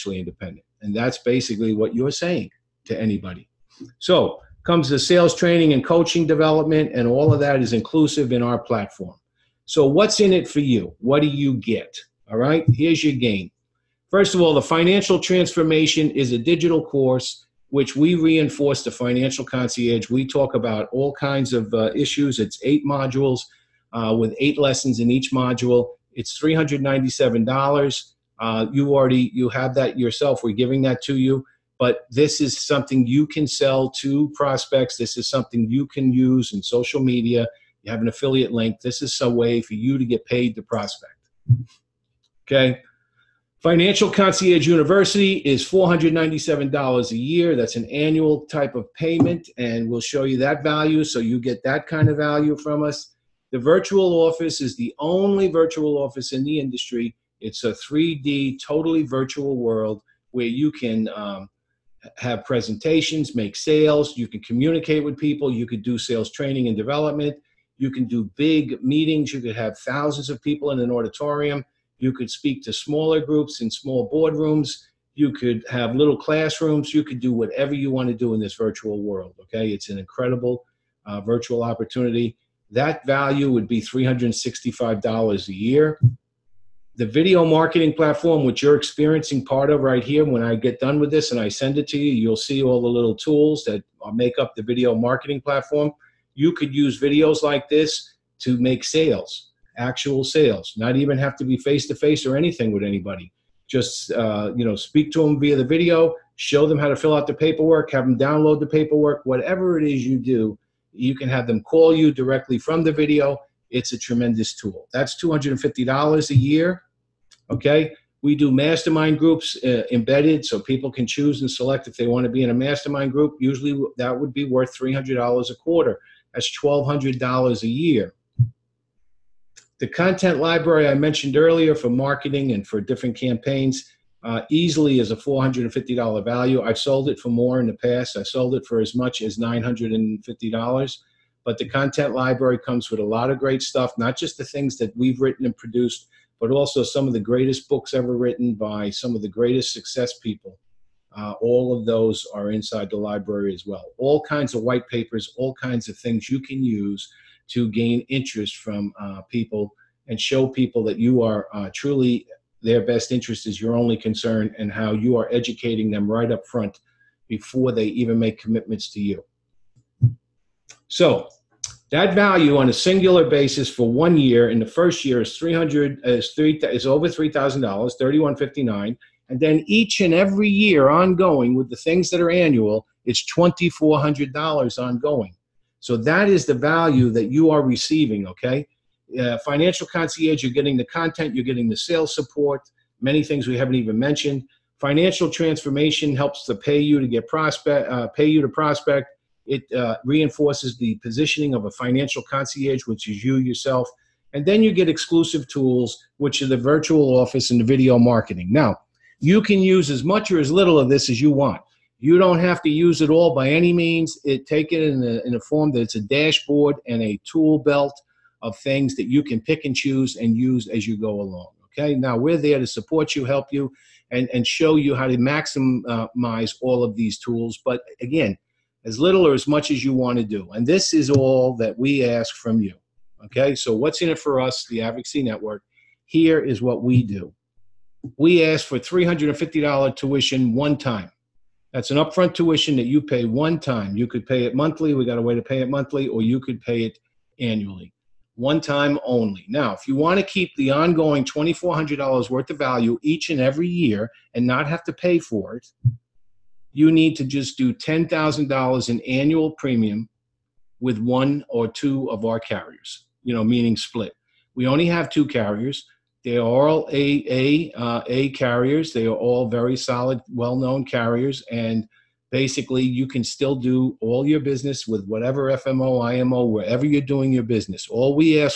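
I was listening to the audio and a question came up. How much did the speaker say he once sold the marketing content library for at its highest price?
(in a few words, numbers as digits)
$950.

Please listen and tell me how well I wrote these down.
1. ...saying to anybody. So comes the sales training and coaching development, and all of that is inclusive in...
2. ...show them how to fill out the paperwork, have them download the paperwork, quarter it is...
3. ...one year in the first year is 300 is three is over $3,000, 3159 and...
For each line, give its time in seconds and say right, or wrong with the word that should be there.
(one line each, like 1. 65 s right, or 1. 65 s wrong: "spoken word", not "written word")
1. 2 s right
2. 106 s wrong: "whatever", not "quarter"
3. 173 s right.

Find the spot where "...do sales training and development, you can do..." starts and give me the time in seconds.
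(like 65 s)
65 s.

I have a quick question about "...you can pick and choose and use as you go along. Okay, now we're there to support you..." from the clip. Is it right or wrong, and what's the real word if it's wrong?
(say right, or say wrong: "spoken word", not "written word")
right.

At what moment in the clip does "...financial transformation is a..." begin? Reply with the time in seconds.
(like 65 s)
14 s.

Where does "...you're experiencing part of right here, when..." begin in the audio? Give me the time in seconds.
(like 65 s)
88 s.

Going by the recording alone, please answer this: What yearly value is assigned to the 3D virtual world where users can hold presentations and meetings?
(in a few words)
$365.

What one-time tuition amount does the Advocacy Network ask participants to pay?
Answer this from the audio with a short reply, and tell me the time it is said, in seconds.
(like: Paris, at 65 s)
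$350, at 238 s.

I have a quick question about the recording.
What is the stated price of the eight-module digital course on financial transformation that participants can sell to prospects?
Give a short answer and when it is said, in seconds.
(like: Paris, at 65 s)
$397, at 26 s.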